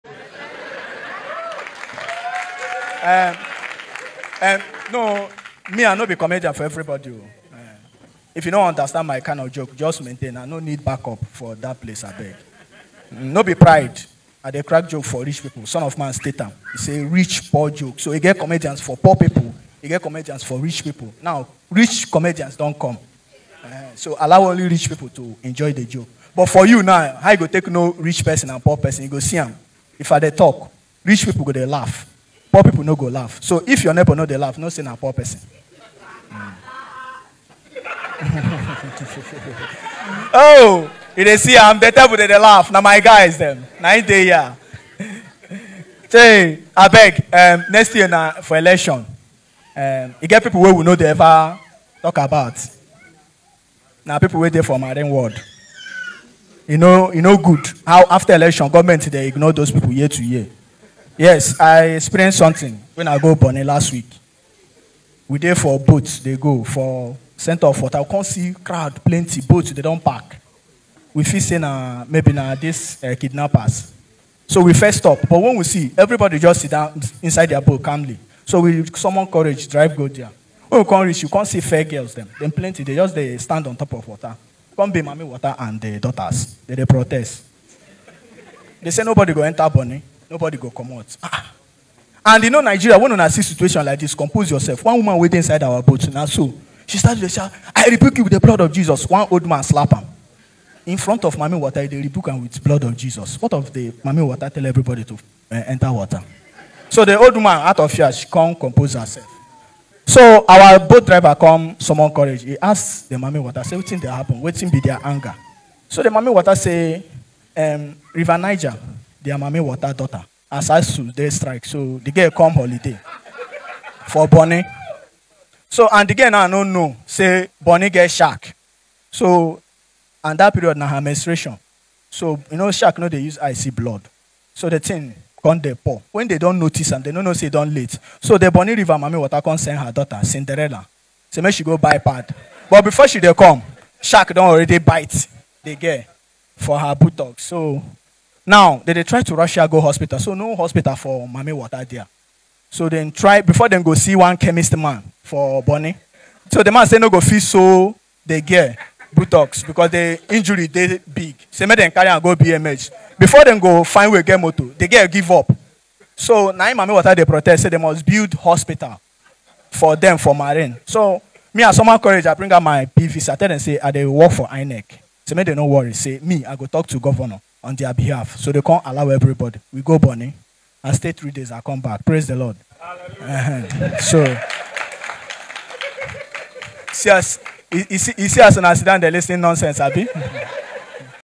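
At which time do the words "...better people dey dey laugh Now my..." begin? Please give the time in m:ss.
0:41.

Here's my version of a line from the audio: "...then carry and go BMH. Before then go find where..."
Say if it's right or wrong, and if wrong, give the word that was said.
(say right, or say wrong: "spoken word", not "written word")
right.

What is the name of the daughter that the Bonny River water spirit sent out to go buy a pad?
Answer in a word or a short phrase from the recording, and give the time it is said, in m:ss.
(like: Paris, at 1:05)
Cinderella, at 2:20.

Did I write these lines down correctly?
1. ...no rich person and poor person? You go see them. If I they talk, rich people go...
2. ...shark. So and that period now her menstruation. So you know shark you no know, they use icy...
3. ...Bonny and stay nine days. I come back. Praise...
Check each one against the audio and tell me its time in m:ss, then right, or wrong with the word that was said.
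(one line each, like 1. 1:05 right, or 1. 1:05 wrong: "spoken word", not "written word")
1. 0:27 right
2. 2:08 right
3. 2:59 wrong: "three", not "nine".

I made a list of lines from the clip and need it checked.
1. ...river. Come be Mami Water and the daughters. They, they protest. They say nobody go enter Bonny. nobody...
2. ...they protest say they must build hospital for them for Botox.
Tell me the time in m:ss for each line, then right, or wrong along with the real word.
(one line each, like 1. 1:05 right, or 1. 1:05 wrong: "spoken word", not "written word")
1. 1:24 wrong: "water", not "river"
2. 2:47 wrong: "Marine", not "Botox".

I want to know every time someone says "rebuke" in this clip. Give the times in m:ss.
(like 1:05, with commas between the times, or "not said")
1:37, 1:42.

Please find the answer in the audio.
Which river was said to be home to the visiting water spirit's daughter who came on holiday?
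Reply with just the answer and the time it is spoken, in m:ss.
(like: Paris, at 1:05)
River Niger, at 1:58.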